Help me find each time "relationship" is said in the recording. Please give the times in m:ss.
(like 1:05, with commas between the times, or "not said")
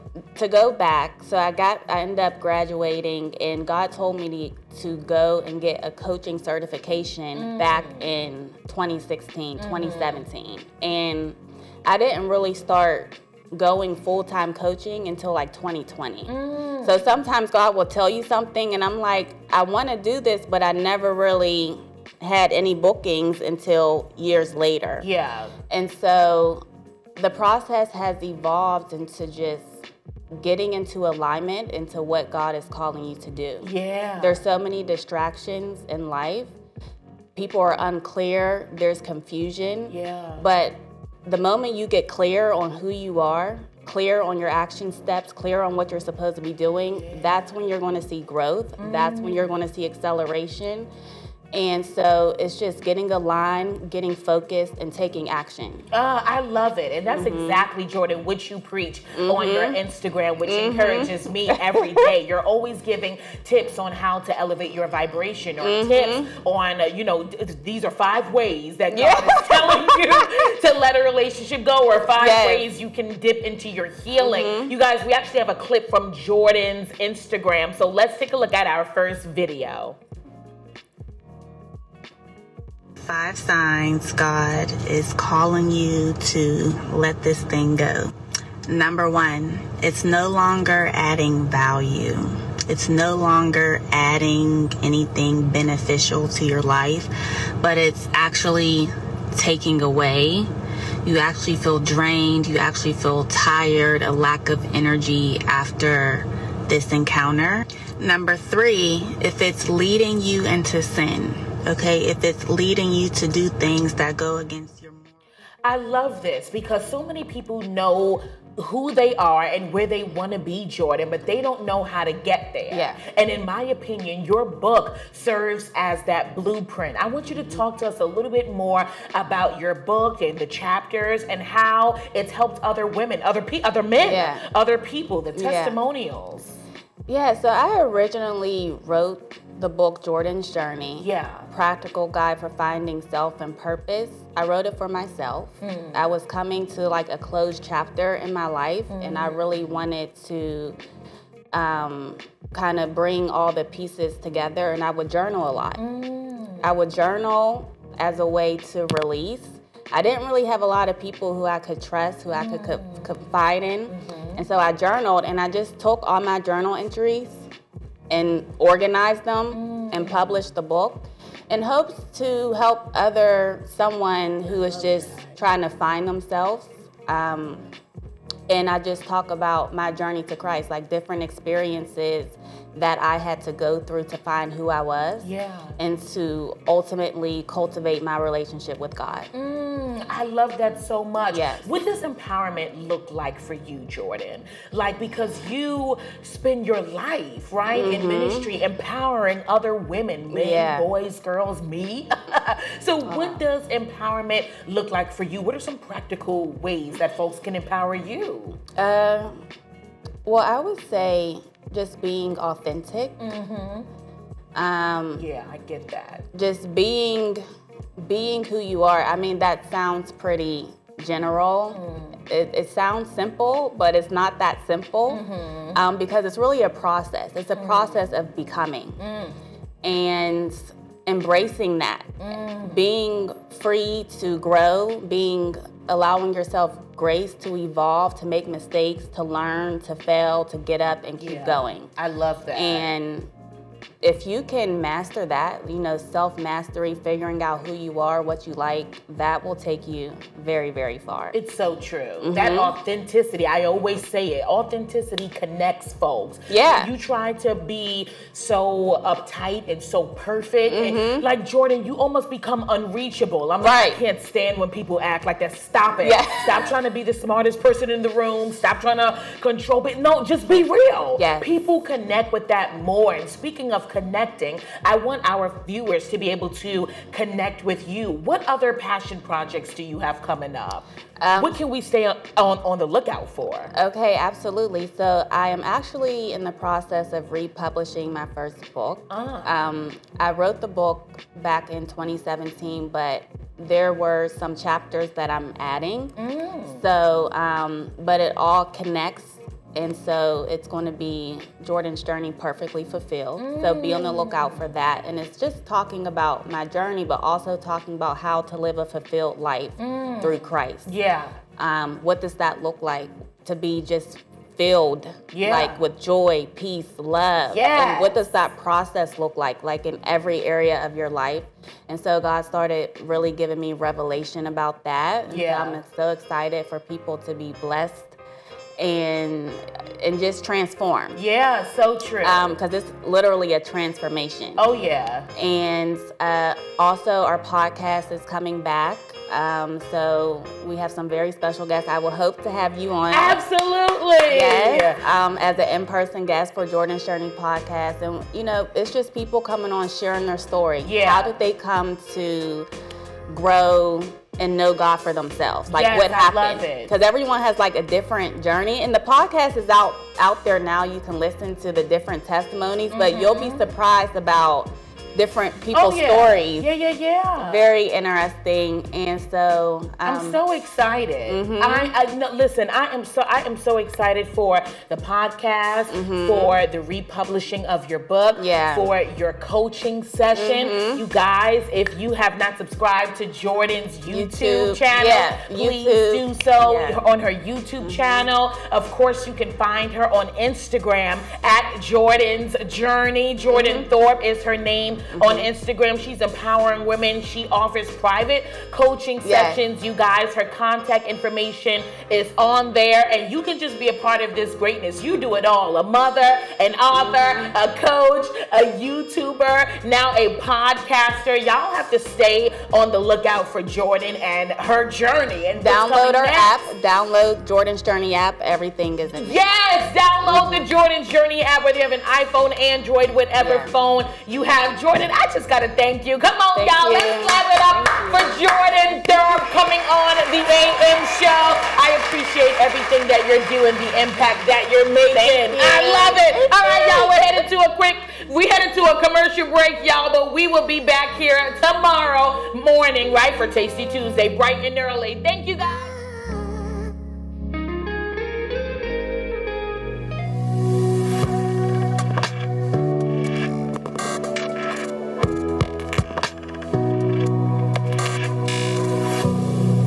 1:11, 3:08.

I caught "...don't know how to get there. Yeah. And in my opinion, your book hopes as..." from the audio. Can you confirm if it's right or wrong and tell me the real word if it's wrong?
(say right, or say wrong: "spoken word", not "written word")
wrong: "serves", not "hopes".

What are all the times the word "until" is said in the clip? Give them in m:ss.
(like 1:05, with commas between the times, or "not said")
0:15, 0:23.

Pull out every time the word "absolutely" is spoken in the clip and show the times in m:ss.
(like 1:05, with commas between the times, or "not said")
4:44, 5:43.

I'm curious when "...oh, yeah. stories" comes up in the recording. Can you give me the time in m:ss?
6:05.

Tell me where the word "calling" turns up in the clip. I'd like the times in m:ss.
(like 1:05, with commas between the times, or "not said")
0:32, 1:25.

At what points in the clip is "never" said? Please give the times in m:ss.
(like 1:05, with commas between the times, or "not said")
0:20.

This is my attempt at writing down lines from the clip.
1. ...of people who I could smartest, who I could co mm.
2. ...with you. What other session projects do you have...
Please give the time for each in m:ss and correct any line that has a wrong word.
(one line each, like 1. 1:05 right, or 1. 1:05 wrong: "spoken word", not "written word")
1. 2:40 wrong: "trust", not "smartest"
2. 4:37 wrong: "passion", not "session".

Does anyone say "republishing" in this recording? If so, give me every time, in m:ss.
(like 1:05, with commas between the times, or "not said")
4:47, 6:16.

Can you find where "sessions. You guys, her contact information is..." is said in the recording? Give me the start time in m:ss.
6:39.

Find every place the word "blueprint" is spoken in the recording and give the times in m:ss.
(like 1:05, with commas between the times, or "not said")
2:06.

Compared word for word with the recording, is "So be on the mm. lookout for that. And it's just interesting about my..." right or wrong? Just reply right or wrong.
wrong.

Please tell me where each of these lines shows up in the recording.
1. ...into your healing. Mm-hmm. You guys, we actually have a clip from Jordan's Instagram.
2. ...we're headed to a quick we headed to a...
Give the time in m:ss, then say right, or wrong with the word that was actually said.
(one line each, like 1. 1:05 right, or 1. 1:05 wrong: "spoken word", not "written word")
1. 1:13 right
2. 7:17 right.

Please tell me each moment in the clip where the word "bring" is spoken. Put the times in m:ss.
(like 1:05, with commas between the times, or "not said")
2:32.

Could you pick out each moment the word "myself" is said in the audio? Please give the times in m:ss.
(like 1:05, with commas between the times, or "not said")
2:24.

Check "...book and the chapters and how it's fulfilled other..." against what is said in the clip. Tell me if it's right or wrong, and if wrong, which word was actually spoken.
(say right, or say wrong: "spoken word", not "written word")
wrong: "helped", not "fulfilled".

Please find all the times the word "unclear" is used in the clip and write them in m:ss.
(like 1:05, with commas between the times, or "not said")
0:37.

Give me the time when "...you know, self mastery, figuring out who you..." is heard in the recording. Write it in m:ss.
4:05.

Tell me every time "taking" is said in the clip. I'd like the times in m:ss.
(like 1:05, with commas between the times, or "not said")
0:54, 1:39.